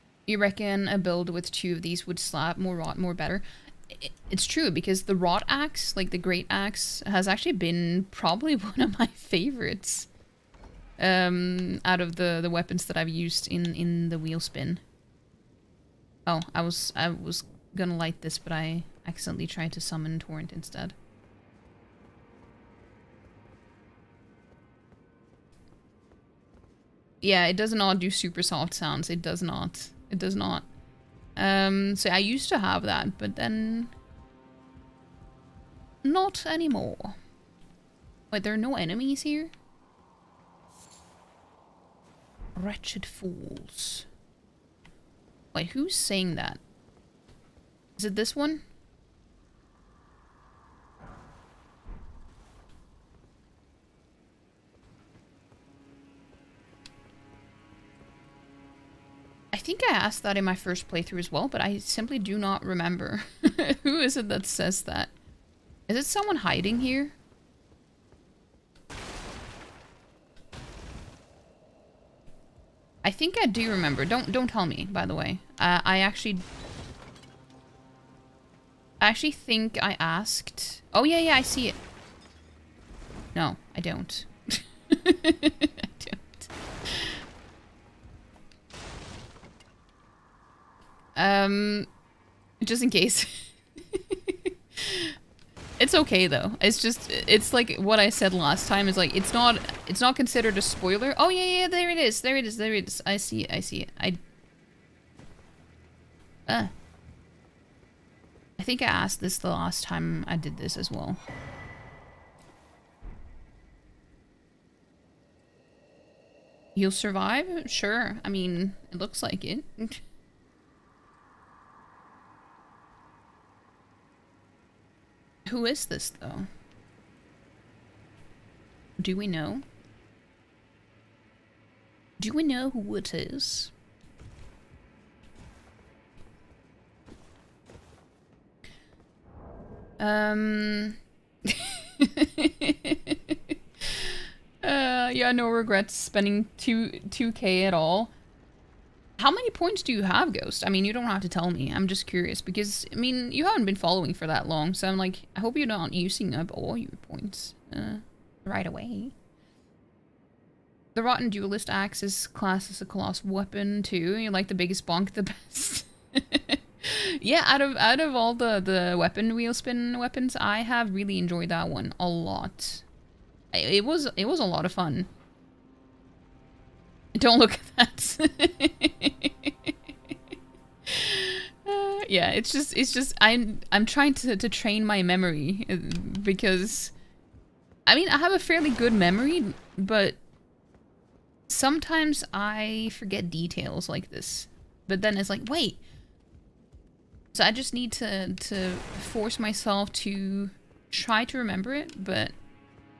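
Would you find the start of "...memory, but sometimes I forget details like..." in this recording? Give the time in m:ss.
3:08.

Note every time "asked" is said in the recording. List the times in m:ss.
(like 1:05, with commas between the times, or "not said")
0:59, 1:19, 1:48.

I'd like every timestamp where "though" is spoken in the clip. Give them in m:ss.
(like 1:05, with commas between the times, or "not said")
1:36, 2:06.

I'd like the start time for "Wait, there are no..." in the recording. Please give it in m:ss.
0:38.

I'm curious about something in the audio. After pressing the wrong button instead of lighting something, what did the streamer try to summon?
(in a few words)
Torrent.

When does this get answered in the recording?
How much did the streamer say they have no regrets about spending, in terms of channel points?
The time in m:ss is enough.
2:27.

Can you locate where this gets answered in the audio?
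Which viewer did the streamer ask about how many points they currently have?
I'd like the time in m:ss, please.
2:30.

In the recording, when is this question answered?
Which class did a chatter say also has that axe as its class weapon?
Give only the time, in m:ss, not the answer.
2:41.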